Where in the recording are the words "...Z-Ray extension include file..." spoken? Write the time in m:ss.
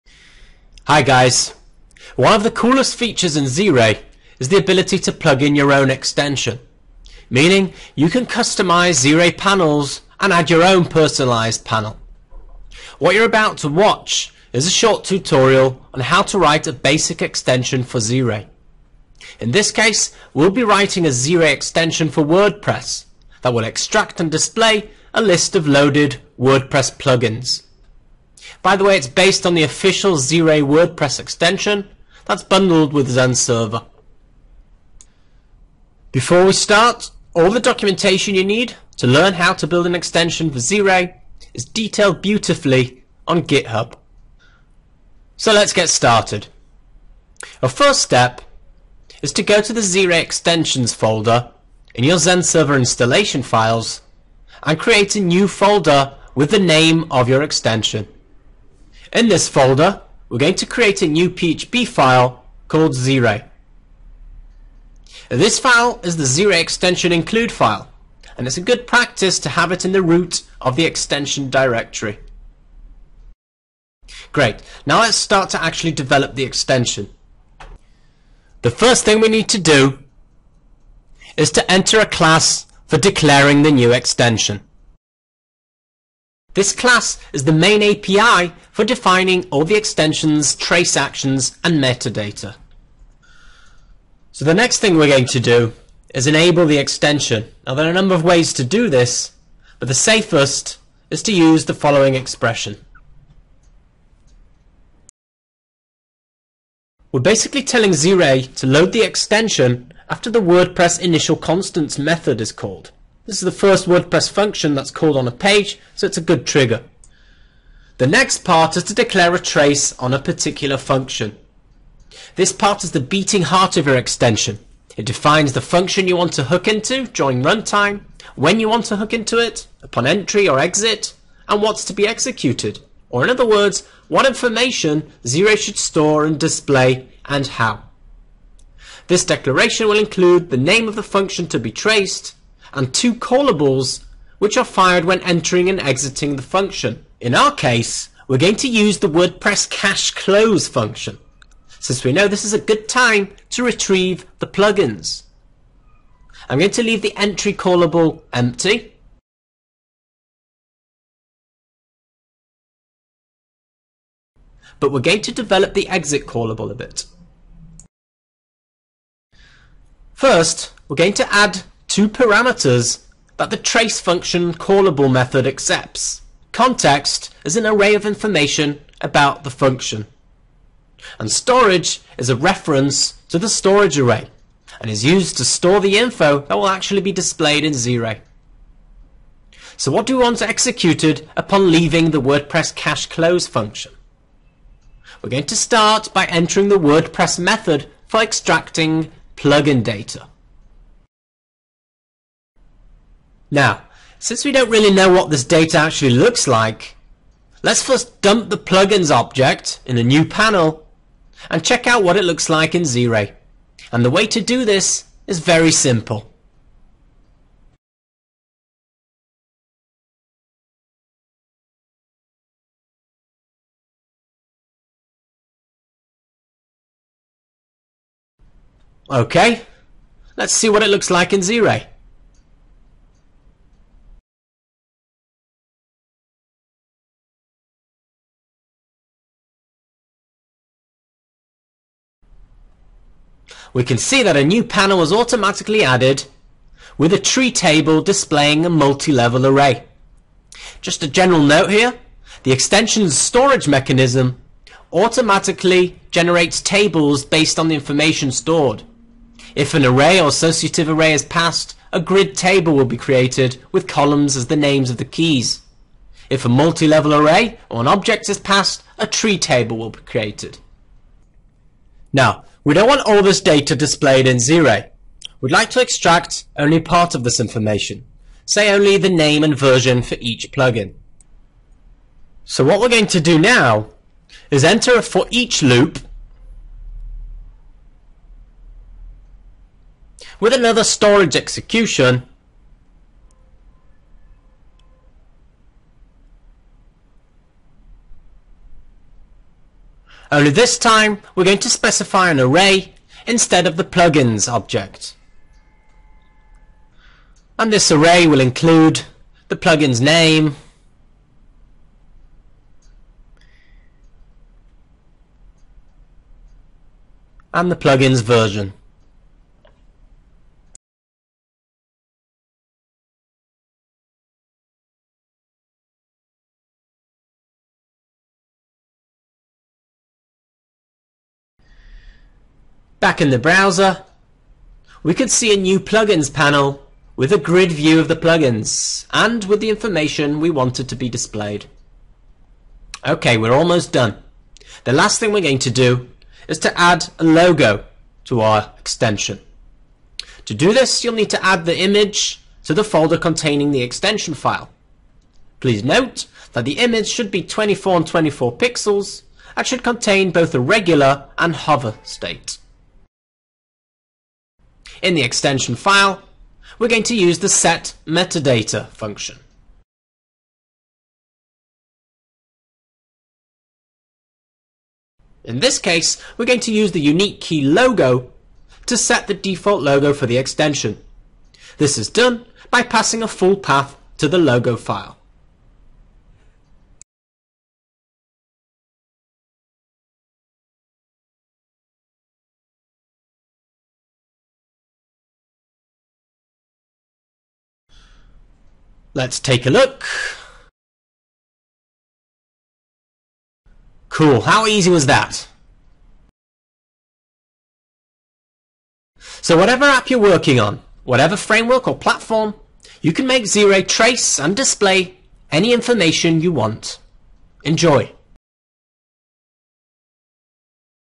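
1:06.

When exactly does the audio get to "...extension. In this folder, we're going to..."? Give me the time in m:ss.
0:57.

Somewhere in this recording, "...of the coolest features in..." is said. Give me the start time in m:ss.
0:02.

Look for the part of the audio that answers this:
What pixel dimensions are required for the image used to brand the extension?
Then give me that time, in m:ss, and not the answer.
5:57.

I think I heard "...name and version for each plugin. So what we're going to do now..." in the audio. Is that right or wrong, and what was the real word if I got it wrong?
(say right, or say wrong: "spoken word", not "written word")
right.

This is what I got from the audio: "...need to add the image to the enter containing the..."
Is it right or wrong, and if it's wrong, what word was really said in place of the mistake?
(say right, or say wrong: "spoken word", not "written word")
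wrong: "folder", not "enter".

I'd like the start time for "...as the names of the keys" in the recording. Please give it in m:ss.
4:24.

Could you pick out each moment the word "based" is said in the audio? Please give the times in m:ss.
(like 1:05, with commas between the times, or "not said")
0:29, 4:17.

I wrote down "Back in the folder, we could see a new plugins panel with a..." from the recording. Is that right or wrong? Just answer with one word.
wrong.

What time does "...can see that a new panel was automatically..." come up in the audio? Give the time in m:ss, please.
4:03.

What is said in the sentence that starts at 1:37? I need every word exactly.
Now there are a number of ways to do this, but the safest is to use the following expression.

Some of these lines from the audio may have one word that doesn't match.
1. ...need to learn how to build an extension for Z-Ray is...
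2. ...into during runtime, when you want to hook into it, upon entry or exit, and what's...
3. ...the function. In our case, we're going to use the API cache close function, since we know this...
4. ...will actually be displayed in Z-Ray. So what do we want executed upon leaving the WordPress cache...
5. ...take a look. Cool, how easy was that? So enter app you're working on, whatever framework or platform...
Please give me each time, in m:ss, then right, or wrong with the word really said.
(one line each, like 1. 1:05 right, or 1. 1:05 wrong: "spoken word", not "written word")
1. 0:38 right
2. 2:06 right
3. 2:26 wrong: "WordPress", not "API"
4. 3:06 right
5. 6:39 wrong: "whatever", not "enter".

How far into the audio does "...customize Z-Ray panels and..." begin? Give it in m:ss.
0:08.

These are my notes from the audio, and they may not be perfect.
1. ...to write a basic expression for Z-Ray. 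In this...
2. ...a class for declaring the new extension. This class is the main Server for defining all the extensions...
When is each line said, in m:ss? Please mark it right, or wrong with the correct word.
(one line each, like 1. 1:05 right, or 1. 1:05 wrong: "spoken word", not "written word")
1. 0:16 wrong: "extension", not "expression"
2. 1:21 wrong: "API", not "Server".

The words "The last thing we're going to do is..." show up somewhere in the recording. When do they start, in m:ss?
5:44.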